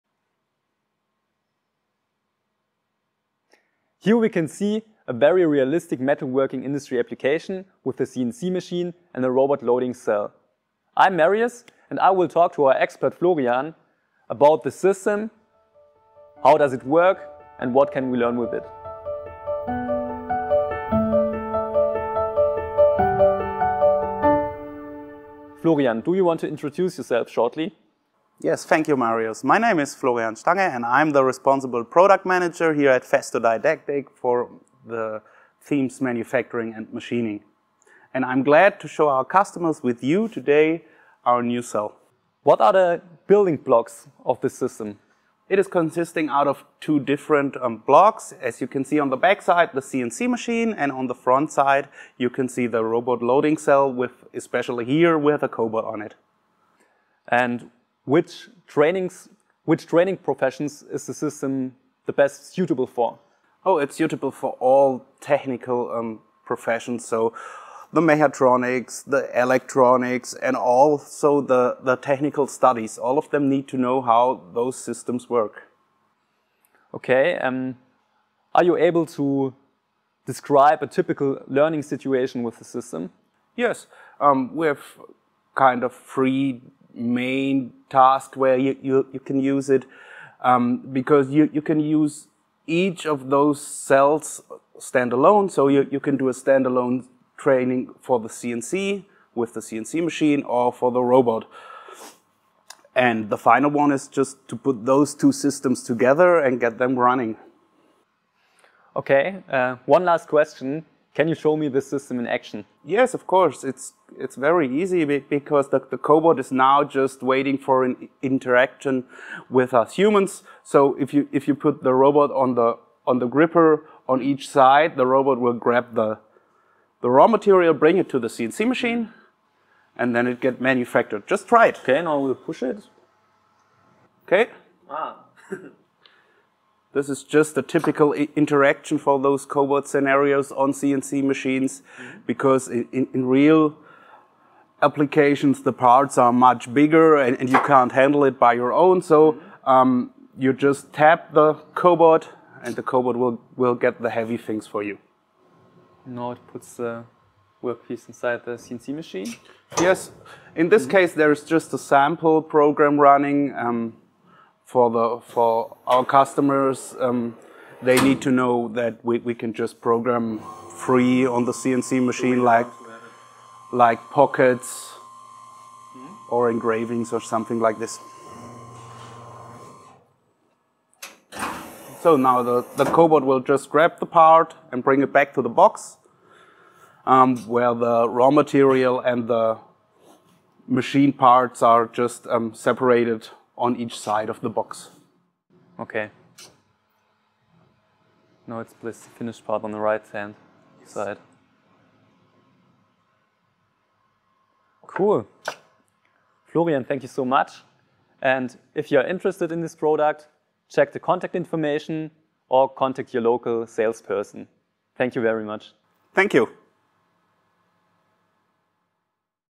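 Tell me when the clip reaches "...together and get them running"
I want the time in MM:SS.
01:45.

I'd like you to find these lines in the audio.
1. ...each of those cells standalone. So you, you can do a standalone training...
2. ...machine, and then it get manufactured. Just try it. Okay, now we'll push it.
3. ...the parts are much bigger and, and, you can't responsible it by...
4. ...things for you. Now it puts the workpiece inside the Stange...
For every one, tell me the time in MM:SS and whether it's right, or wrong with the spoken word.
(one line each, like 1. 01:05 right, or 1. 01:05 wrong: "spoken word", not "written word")
1. 01:32 right
2. 02:08 right
3. 02:25 wrong: "handle", not "responsible"
4. 02:34 wrong: "CNC", not "Stange".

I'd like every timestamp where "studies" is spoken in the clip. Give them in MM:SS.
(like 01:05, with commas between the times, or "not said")
01:12.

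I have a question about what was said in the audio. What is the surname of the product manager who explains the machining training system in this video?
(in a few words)
Stange.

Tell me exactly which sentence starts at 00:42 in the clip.
What are the building blocks of this system?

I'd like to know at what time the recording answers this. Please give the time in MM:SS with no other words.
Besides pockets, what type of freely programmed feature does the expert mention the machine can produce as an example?
02:56.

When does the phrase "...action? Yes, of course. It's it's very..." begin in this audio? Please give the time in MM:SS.
01:52.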